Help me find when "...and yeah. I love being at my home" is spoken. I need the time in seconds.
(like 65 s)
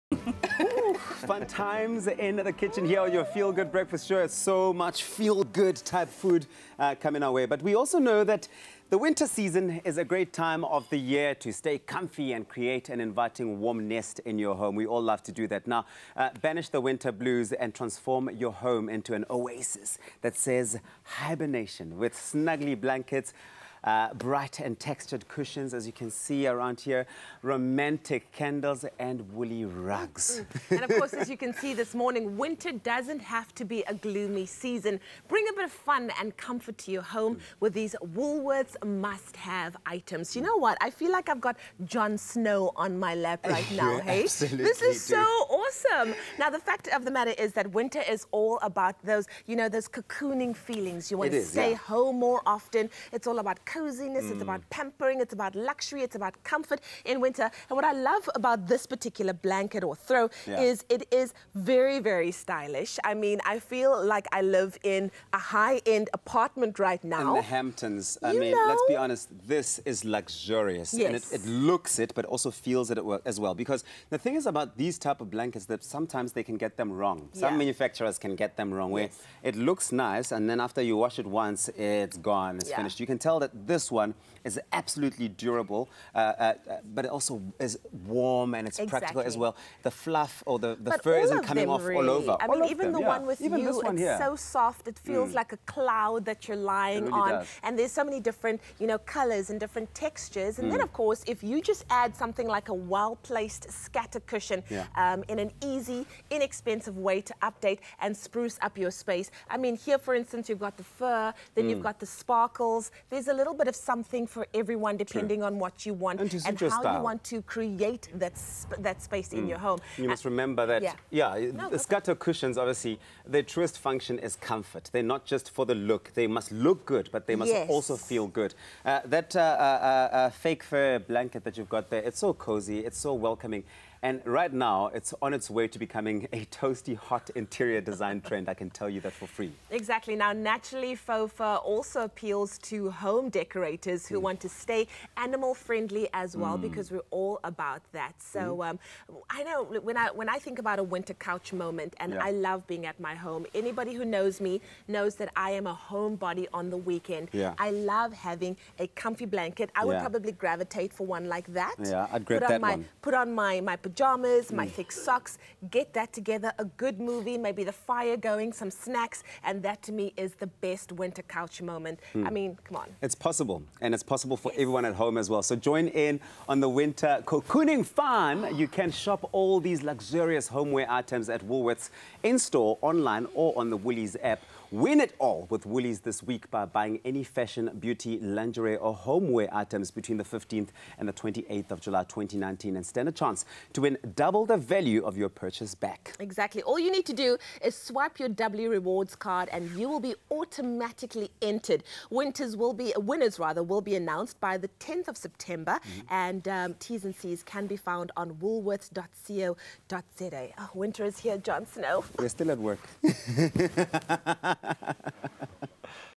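151 s.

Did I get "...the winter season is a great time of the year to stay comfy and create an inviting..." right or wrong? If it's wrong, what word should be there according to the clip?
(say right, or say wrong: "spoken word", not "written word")
right.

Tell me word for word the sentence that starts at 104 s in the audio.
um, in an easy, inexpensive way to update and spruce up your space.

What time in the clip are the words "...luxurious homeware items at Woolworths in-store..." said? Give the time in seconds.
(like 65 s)
179 s.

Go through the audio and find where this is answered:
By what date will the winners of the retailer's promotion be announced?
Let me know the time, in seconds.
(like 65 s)
204 s.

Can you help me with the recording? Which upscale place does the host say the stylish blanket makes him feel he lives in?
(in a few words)
The Hamptons.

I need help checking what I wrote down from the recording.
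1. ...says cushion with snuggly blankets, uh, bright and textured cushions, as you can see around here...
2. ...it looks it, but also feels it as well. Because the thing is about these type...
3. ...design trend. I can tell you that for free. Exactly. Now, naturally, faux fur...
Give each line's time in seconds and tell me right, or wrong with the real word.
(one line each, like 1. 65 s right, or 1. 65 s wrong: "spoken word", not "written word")
1. 20 s wrong: "hibernation", not "cushion"
2. 71 s right
3. 137 s right.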